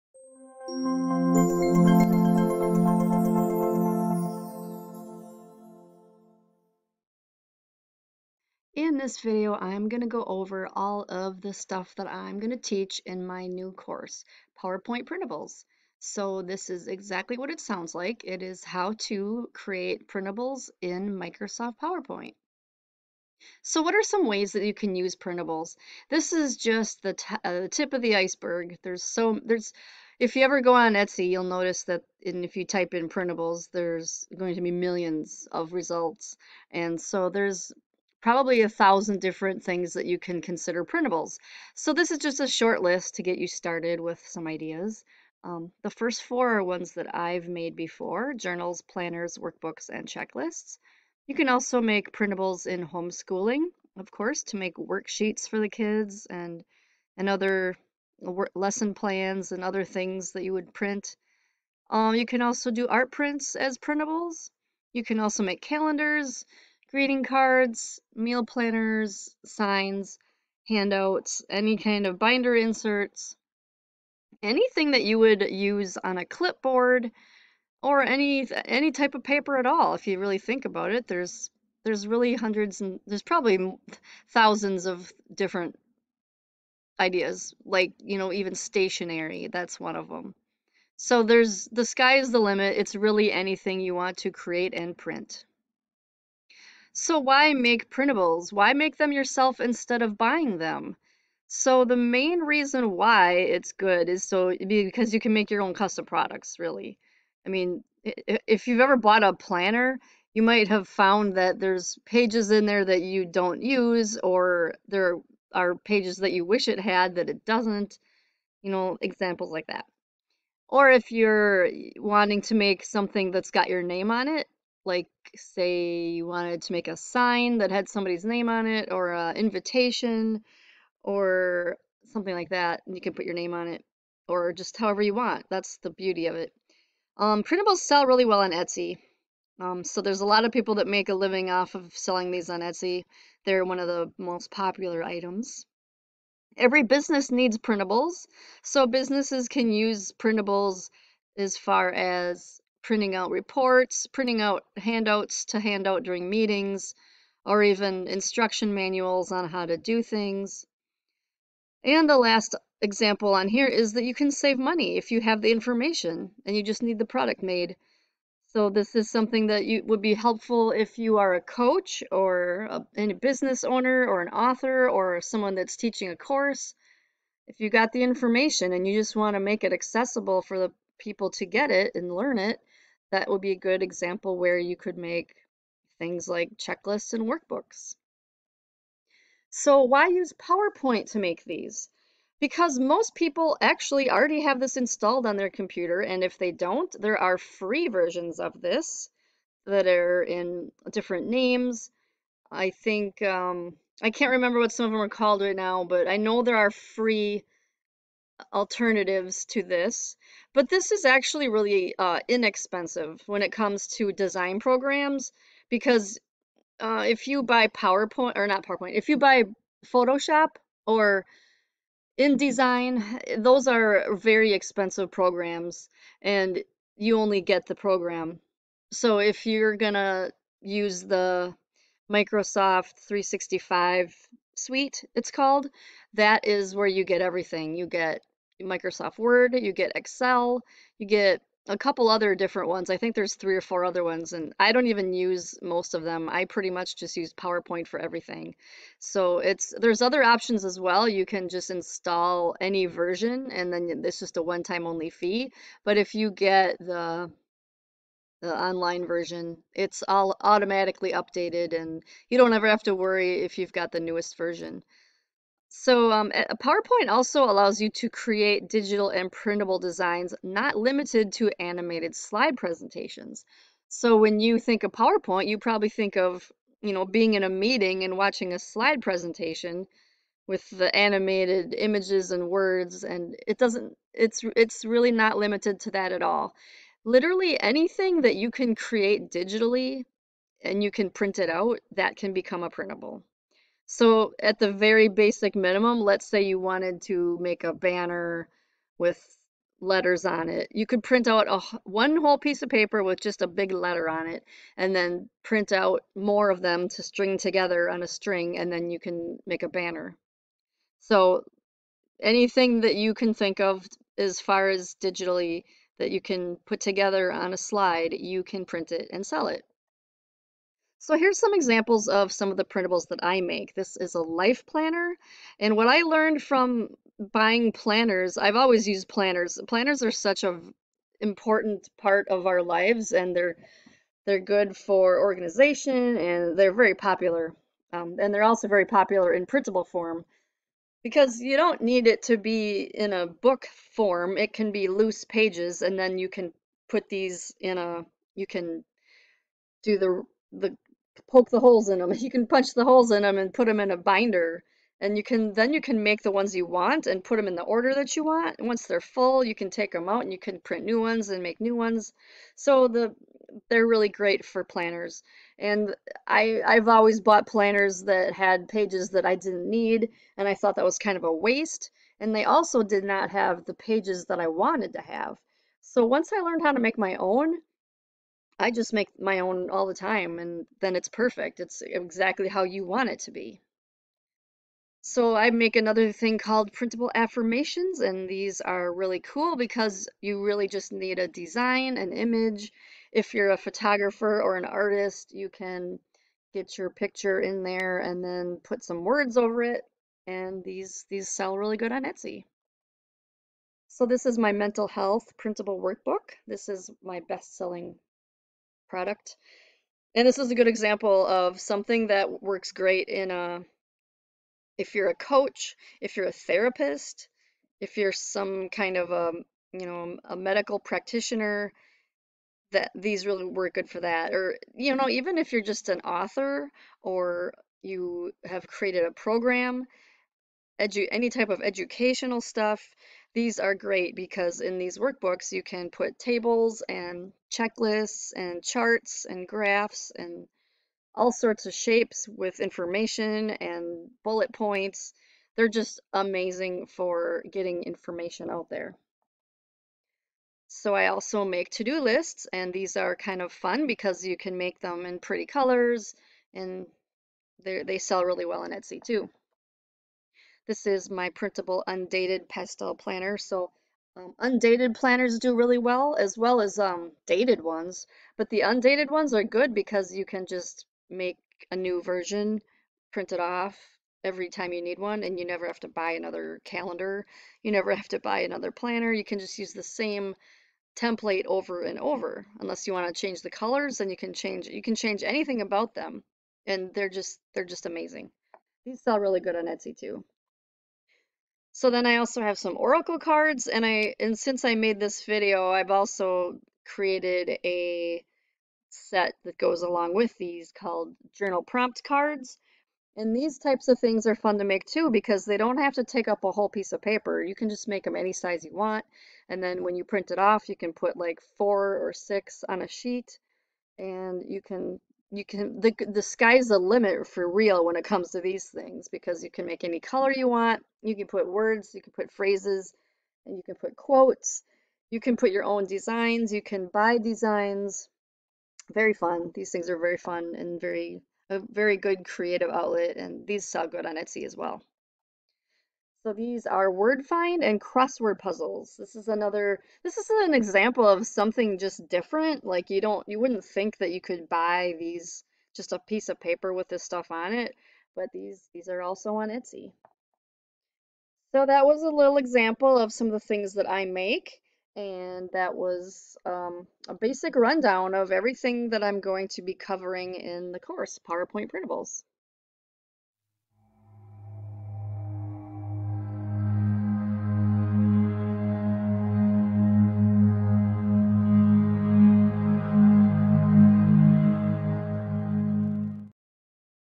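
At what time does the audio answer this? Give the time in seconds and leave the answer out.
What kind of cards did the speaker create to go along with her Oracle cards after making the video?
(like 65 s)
501 s.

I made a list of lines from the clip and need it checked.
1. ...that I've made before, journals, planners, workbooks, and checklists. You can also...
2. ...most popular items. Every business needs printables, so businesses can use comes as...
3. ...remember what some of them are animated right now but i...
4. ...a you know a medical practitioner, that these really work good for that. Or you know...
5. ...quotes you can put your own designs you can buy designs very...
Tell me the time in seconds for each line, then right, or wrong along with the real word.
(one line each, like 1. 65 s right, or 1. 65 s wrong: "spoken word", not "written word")
1. 46 s right
2. 144 s wrong: "printables", not "comes"
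3. 204 s wrong: "called", not "animated"
4. 419 s right
5. 523 s right.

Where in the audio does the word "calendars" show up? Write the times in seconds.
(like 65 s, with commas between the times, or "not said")
65 s, 476 s.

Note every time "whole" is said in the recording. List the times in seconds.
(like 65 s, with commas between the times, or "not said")
302 s, 506 s.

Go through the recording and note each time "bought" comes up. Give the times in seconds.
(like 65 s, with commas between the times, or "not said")
108 s, 367 s.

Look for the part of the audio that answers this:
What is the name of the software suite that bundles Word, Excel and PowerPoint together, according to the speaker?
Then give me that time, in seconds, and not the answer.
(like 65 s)
232 s.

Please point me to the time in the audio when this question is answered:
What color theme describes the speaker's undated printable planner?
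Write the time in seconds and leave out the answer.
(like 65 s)
462 s.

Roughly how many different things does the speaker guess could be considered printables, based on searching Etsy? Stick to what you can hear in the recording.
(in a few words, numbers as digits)
1,000.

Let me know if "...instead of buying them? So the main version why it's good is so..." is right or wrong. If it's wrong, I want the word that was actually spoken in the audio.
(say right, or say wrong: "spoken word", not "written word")
wrong: "reason", not "version".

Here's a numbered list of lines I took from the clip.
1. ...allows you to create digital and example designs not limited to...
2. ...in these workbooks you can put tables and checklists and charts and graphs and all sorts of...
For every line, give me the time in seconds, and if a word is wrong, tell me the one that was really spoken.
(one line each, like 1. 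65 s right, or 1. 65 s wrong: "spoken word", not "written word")
1. 267 s wrong: "printable", not "example"
2. 434 s right.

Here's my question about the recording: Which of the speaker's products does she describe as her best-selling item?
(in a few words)
mental health printable workbook.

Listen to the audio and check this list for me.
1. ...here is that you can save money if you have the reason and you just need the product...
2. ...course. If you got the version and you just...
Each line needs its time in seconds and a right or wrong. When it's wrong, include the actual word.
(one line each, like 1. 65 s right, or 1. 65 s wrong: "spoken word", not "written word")
1. 163 s wrong: "information", not "reason"
2. 176 s wrong: "information", not "version".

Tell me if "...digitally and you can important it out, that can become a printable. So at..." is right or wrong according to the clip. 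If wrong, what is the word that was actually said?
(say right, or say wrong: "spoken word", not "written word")
wrong: "print", not "important".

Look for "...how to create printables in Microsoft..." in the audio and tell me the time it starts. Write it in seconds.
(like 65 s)
18 s.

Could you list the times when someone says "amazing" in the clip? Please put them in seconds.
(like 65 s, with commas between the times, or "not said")
446 s, 487 s.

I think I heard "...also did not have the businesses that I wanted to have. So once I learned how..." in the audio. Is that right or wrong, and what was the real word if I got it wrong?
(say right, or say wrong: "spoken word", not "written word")
wrong: "pages", not "businesses".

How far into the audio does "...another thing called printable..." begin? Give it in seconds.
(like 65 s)
385 s.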